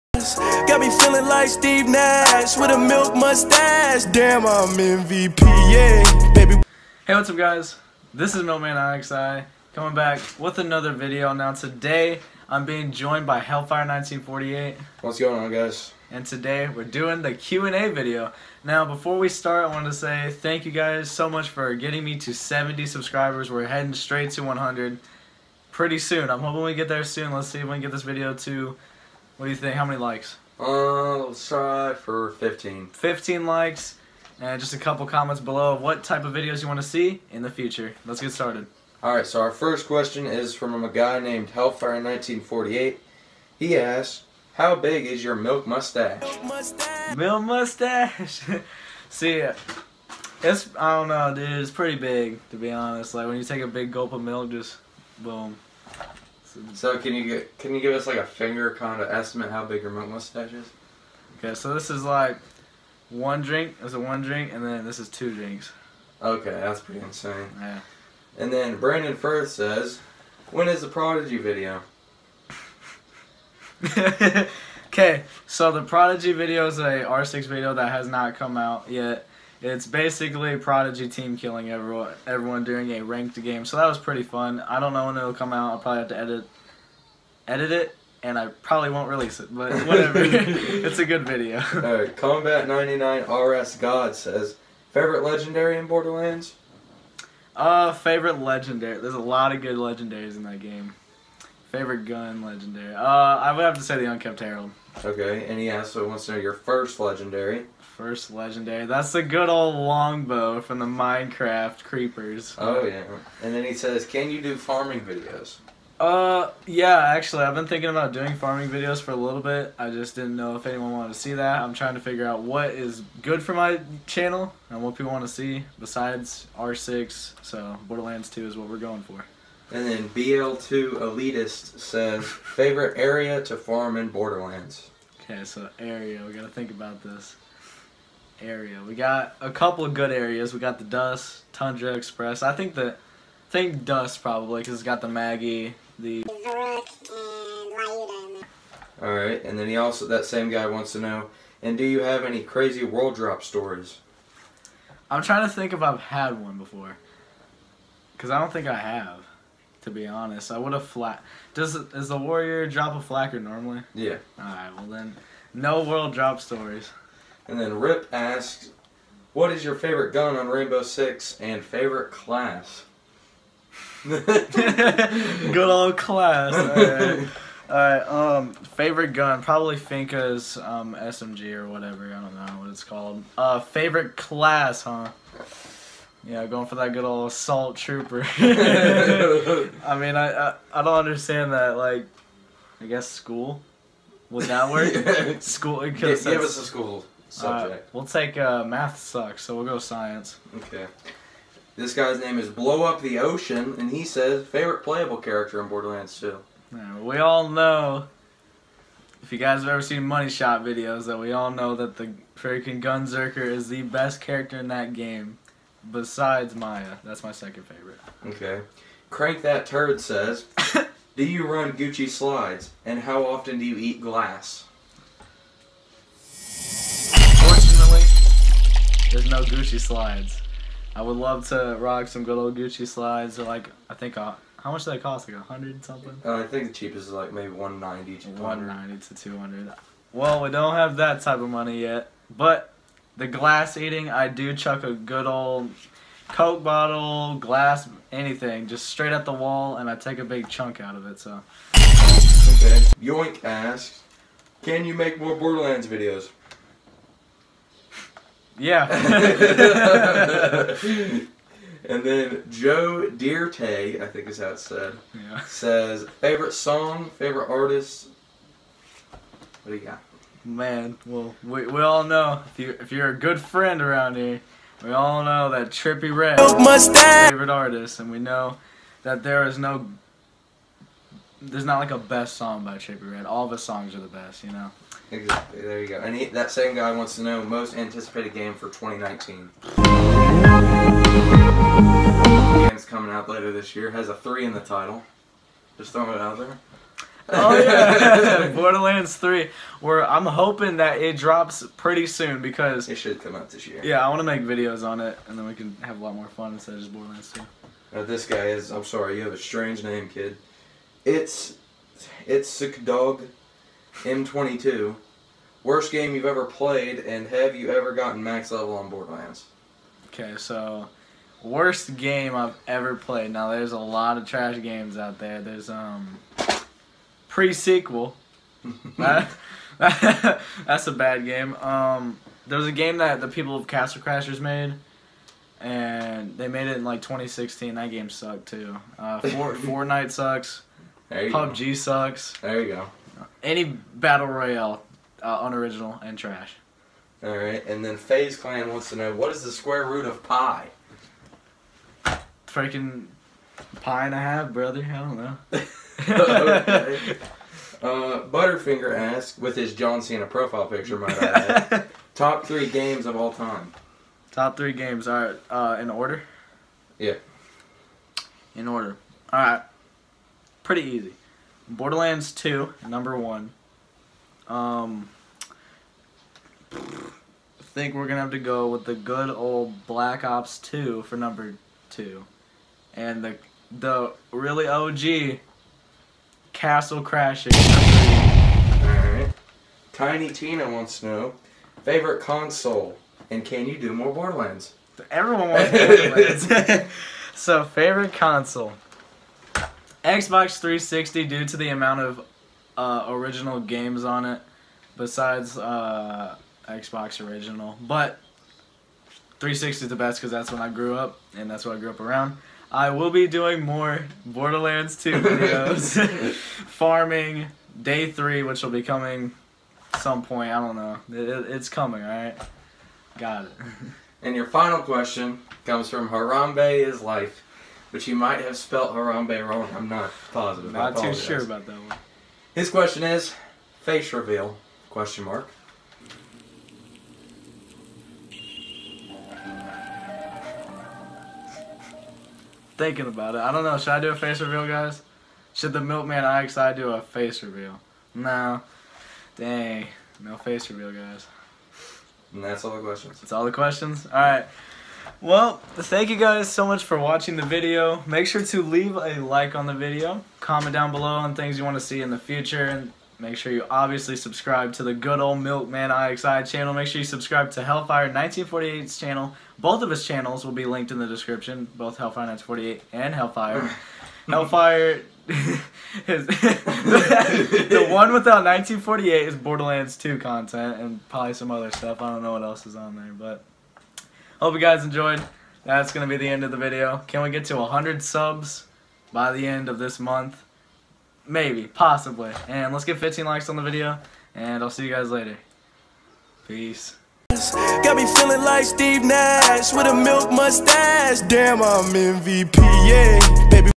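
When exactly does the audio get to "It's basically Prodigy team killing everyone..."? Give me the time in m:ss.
1:19.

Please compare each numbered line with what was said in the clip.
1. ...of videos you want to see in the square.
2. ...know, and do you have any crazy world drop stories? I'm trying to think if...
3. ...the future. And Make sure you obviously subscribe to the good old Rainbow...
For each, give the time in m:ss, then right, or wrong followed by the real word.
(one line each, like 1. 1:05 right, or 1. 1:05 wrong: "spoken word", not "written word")
1. 0:36 wrong: "future", not "square"
2. 2:30 right
3. 7:42 wrong: "Milkman", not "Rainbow".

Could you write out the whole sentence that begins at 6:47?
But 360 is the best because that's when I grew up and that's what I grew up around.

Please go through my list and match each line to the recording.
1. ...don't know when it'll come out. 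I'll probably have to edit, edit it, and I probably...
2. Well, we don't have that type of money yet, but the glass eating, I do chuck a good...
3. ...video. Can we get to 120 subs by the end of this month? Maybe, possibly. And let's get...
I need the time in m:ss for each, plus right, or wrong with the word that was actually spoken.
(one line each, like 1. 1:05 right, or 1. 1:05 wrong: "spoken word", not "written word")
1. 1:24 right
2. 4:00 right
3. 8:06 wrong: "100", not "120".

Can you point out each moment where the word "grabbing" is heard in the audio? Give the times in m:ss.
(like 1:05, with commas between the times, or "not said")
not said.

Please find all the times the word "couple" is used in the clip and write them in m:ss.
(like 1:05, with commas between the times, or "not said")
0:34, 2:19.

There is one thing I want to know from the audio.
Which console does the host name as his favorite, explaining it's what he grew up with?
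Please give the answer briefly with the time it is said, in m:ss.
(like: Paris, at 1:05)
Xbox 360, at 6:40.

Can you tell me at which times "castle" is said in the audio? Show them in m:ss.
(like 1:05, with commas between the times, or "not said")
5:33, 6:26.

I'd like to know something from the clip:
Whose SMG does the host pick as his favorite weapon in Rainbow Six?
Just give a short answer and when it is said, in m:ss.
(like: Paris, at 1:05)
Finka, at 2:59.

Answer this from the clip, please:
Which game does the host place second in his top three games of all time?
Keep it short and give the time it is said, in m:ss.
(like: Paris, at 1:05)
Black Ops 2, at 6:19.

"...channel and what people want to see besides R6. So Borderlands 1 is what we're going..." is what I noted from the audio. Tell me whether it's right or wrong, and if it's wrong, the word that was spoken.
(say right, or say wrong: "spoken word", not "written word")
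wrong: "2", not "1".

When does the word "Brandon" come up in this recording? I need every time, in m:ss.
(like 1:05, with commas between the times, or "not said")
1:08.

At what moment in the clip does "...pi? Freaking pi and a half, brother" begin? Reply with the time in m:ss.
5:50.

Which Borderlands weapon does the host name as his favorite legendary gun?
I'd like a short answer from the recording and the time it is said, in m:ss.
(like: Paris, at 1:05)
Unkempt Harold, at 1:44.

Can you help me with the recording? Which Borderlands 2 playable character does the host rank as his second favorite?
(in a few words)
Maya.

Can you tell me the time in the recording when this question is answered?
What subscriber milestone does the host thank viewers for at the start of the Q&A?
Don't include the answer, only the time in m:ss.
0:22.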